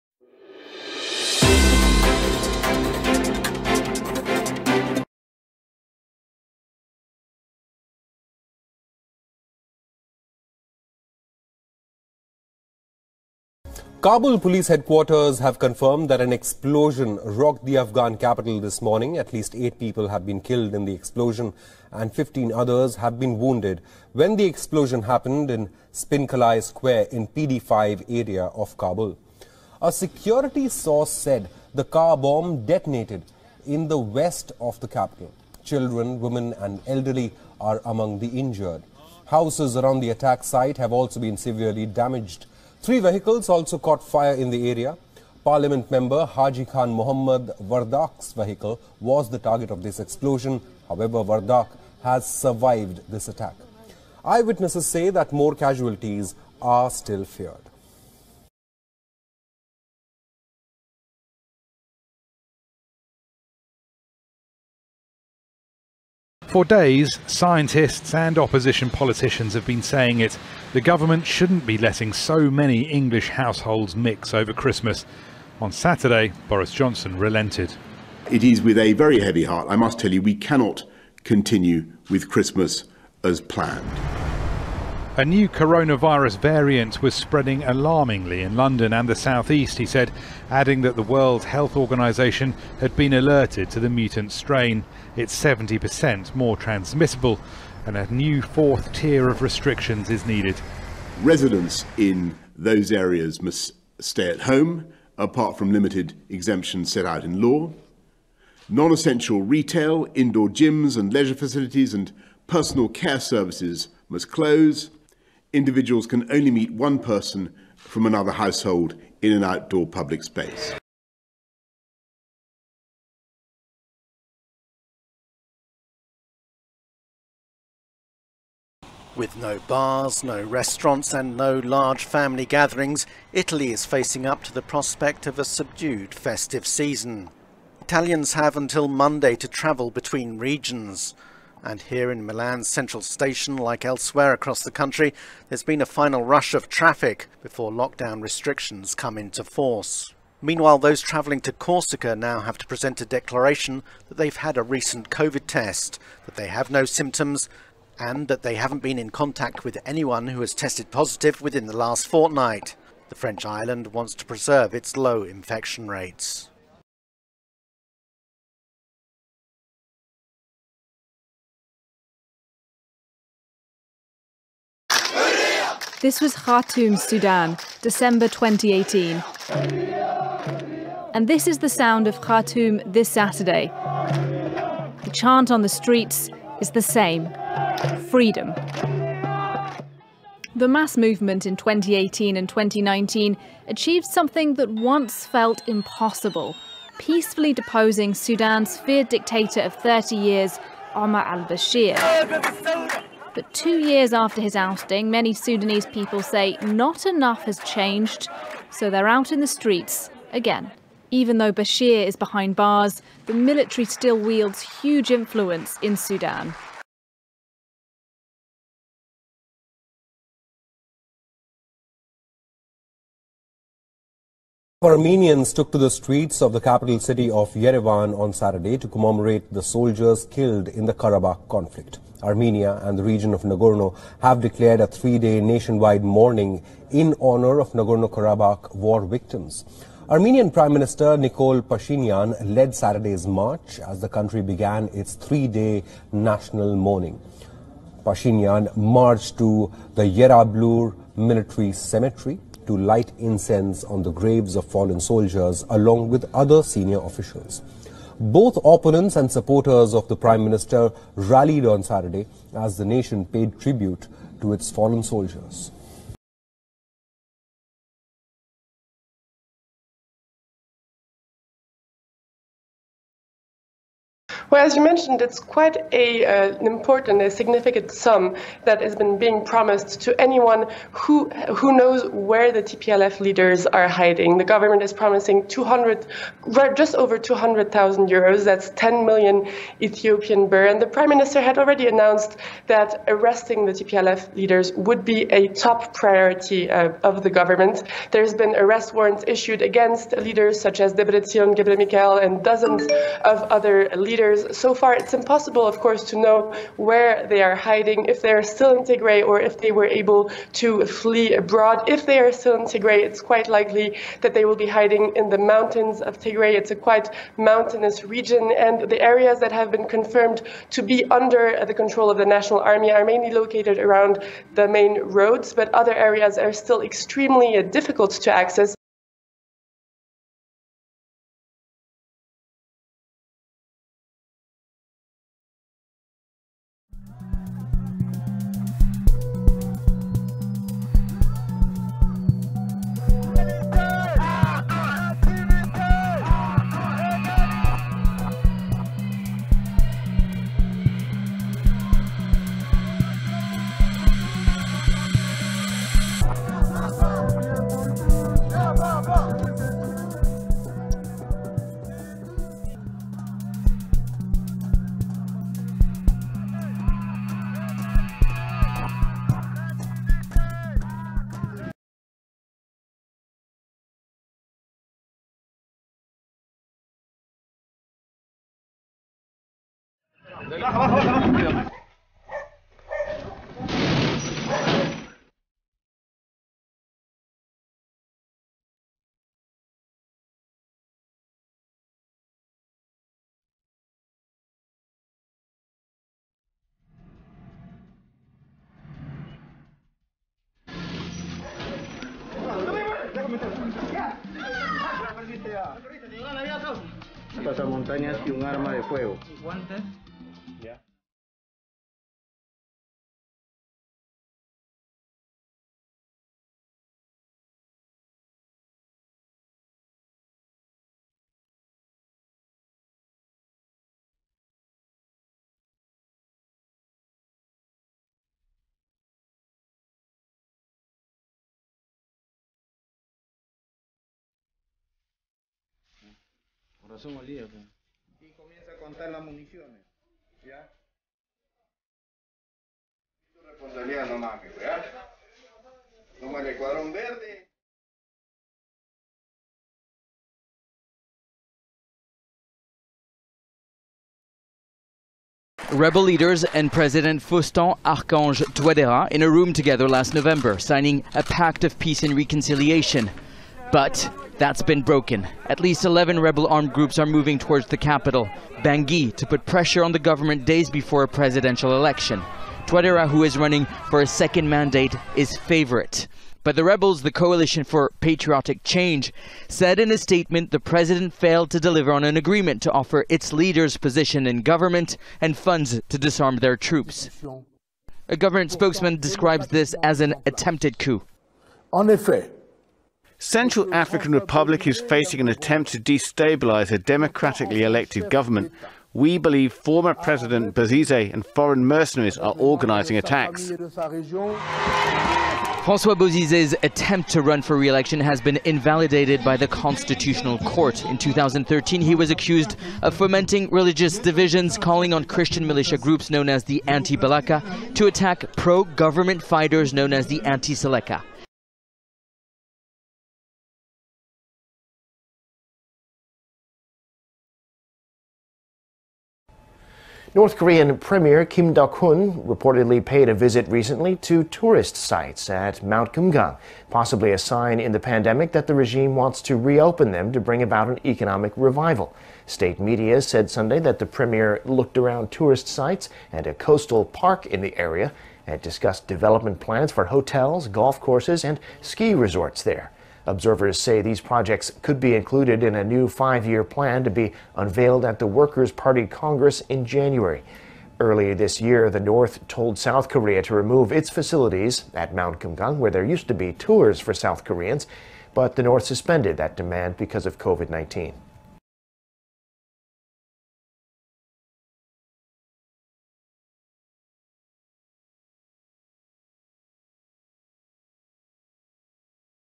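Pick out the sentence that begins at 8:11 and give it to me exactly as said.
En effet, Central African Republic is facing an attempt to destabilize a democratically elected government.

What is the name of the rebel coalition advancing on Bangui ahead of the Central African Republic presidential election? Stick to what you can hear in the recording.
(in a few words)
Coalition for Patriotic Change.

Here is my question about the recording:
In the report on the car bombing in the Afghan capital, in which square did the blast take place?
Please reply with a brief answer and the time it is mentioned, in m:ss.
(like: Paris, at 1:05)
Spin Kalay Square, at 0:25.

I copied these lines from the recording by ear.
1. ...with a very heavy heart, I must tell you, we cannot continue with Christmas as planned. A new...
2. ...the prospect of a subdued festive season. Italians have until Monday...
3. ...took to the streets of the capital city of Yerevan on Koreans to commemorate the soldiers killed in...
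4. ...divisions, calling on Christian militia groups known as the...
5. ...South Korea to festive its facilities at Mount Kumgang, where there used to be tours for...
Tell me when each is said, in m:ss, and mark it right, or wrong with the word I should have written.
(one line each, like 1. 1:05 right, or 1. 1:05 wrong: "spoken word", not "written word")
1. 1:18 right
2. 2:14 right
3. 3:45 wrong: "Saturday", not "Koreans"
4. 8:33 right
5. 9:22 wrong: "remove", not "festive".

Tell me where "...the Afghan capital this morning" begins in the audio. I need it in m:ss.
0:17.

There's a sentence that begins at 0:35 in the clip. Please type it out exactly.
Children, women and elderly are among the injured.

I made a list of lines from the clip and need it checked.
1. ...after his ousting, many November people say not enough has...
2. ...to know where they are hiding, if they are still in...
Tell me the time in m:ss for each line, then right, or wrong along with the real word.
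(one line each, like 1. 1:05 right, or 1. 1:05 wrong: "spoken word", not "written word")
1. 3:24 wrong: "Sudanese", not "November"
2. 5:06 right.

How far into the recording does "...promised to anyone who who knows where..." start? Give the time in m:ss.
4:39.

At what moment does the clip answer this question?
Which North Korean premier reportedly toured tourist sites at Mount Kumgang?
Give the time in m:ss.
8:51.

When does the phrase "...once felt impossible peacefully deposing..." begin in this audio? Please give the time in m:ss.
3:14.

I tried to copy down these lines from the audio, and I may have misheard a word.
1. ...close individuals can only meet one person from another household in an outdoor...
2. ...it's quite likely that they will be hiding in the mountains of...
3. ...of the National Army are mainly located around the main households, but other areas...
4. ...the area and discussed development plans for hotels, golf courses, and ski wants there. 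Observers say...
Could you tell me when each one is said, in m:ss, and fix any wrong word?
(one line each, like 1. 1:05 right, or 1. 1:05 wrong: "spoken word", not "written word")
1. 1:54 right
2. 5:13 right
3. 5:22 wrong: "roads", not "households"
4. 9:07 wrong: "resorts", not "wants".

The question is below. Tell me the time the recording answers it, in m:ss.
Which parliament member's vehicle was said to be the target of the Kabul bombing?
0:46.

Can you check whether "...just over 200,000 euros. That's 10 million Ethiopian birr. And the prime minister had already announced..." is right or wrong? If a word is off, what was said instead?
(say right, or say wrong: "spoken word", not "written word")
right.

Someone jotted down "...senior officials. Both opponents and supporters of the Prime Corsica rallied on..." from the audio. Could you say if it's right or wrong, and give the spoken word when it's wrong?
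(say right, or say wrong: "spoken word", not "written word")
wrong: "Minister", not "Corsica".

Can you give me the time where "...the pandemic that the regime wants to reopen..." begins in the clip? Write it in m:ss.
8:57.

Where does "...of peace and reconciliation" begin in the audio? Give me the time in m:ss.
7:41.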